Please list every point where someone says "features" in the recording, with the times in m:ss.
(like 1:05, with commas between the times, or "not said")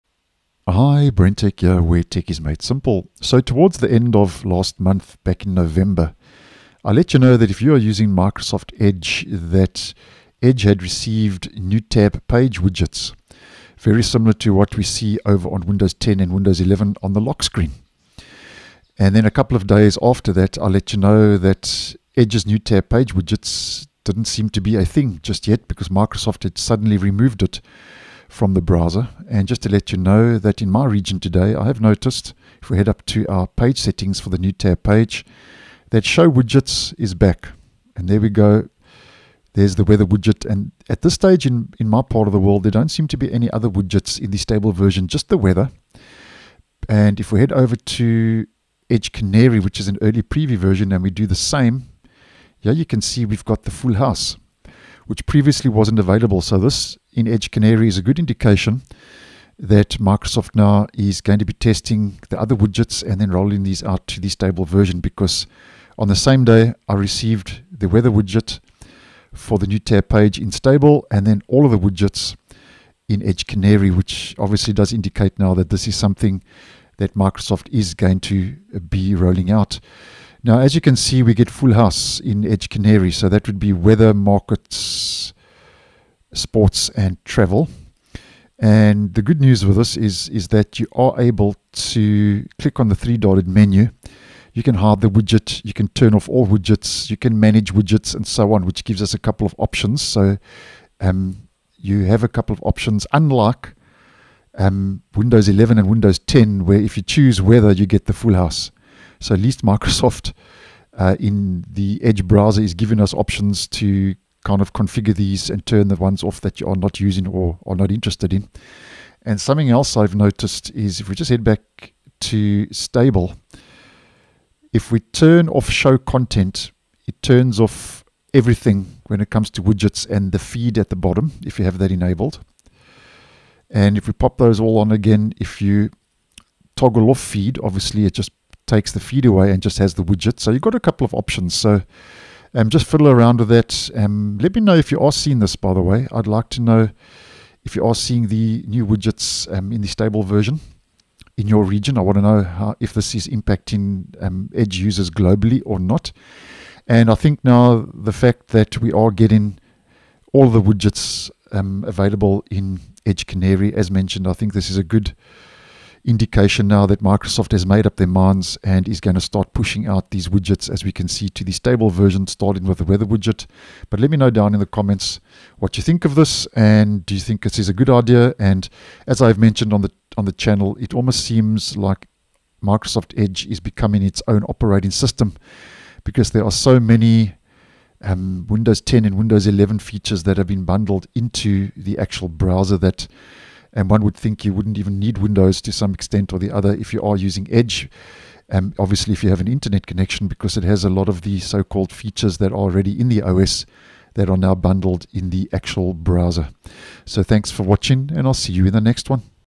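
3:09, 3:21.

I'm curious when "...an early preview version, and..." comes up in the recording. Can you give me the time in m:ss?
0:49.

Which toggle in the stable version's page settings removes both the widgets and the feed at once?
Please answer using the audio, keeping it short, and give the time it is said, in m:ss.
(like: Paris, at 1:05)
Show content, at 2:05.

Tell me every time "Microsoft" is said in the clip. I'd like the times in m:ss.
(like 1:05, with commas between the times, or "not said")
0:08, 0:25, 0:59, 1:17, 1:49, 2:47, 3:02.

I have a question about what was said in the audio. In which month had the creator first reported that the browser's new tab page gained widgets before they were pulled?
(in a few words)
November.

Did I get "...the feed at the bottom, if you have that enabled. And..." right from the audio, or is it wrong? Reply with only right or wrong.
right.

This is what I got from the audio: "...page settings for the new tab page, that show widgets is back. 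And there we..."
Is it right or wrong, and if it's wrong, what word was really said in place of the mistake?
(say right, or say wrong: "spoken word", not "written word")
right.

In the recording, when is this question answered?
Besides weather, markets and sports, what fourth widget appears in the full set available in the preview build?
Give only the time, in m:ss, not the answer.
1:27.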